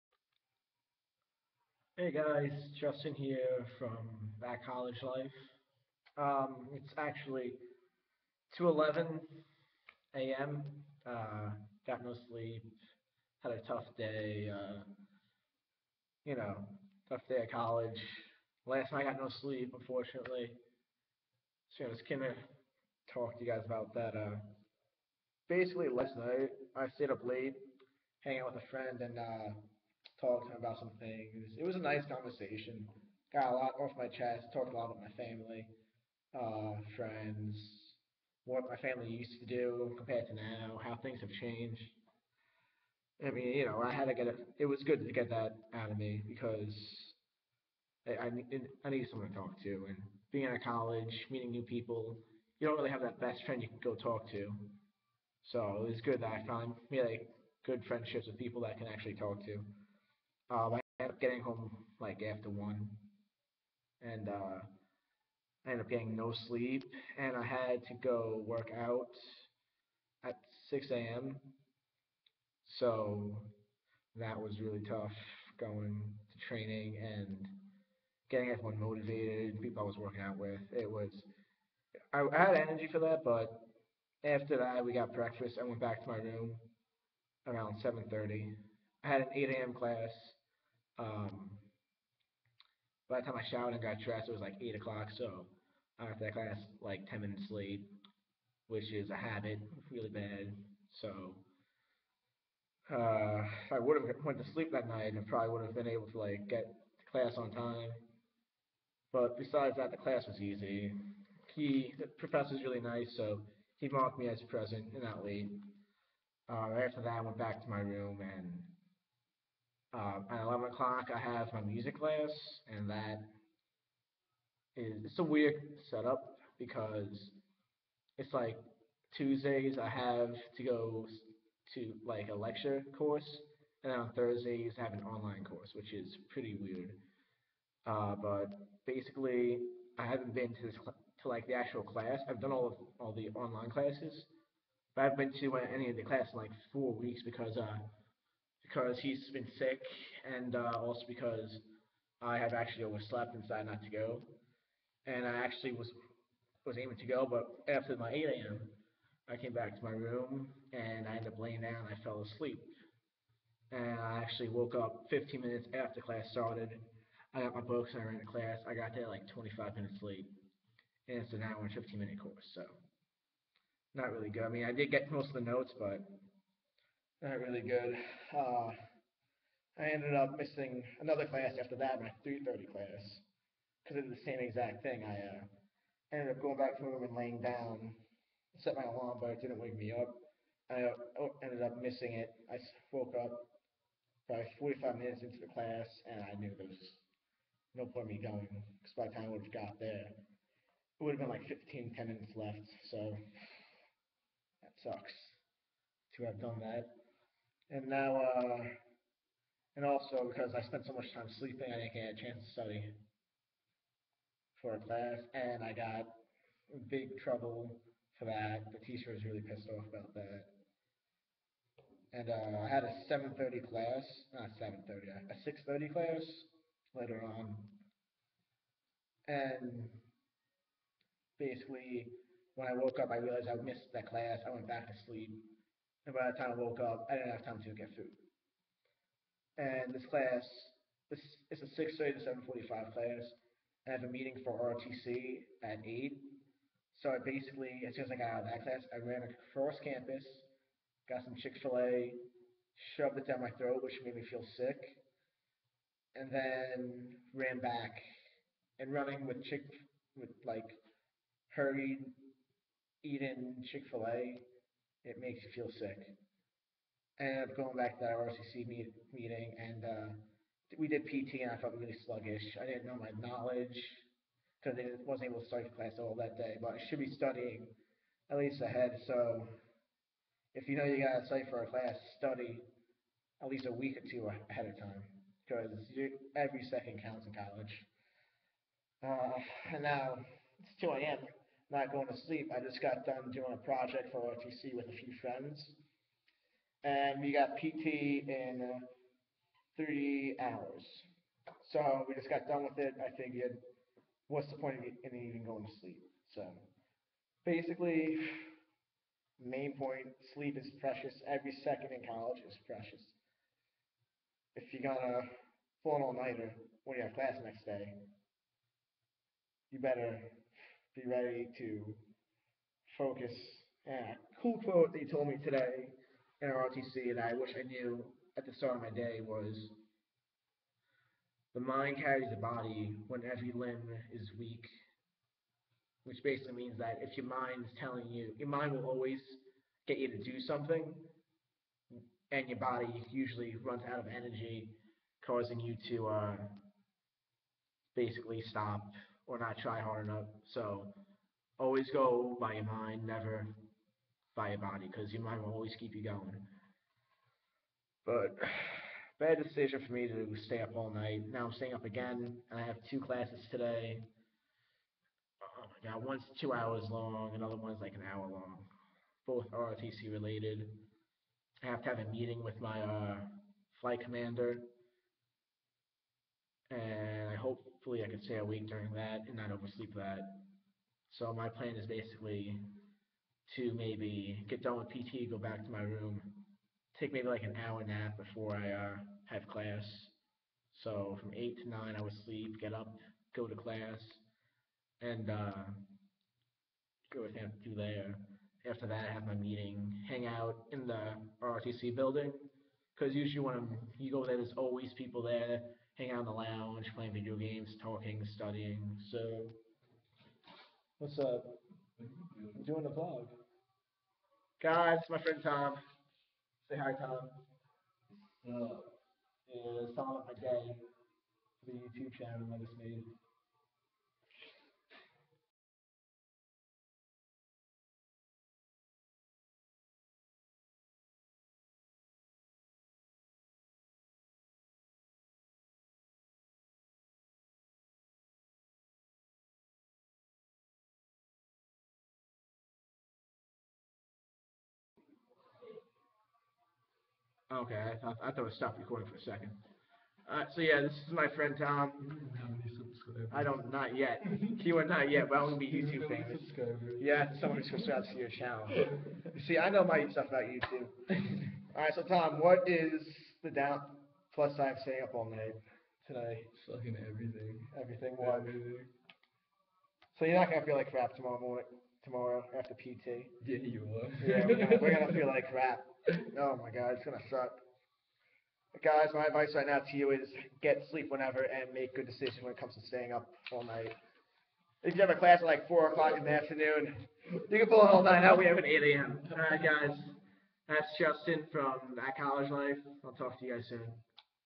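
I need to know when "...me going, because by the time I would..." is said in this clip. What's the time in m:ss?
3:18.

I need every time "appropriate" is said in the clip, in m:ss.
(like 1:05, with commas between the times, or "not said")
not said.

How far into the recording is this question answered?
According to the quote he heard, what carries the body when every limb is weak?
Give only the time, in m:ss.
5:31.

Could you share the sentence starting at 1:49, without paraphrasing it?
But besides that, the class was easy.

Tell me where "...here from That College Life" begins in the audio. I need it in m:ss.
0:03.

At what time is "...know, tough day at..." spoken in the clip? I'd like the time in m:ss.
0:16.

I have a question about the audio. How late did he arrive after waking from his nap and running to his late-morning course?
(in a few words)
25 minutes.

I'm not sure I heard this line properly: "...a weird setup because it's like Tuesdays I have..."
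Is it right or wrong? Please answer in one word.
right.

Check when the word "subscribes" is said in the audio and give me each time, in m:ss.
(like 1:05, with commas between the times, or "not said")
7:37.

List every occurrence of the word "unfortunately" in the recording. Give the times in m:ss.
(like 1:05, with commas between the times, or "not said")
0:19.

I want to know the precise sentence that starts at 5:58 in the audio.
But bad decision for me to stay up all night.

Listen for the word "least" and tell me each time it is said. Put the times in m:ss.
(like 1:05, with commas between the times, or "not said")
4:38, 4:43.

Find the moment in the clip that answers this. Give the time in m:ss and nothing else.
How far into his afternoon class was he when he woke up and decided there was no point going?
3:14.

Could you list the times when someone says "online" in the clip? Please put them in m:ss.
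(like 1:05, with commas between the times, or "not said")
2:15, 2:23.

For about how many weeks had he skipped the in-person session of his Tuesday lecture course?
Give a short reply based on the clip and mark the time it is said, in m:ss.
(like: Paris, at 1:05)
4 weeks, at 2:26.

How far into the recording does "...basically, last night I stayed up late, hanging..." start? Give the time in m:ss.
0:25.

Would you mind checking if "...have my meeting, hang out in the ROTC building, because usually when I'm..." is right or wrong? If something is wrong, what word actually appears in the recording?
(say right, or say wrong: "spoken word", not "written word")
right.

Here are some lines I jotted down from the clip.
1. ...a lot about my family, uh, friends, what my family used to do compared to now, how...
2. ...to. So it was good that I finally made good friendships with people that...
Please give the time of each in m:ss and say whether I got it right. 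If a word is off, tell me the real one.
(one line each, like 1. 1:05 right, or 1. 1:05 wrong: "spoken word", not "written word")
1. 0:34 right
2. 0:54 right.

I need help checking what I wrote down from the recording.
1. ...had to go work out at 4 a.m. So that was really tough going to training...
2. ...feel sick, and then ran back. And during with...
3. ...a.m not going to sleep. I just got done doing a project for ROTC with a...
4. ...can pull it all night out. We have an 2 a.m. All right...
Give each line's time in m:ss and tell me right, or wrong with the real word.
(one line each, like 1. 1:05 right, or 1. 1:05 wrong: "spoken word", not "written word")
1. 1:07 wrong: "6", not "4"
2. 4:14 wrong: "running", not "during"
3. 4:51 right
4. 8:07 wrong: "8", not "2".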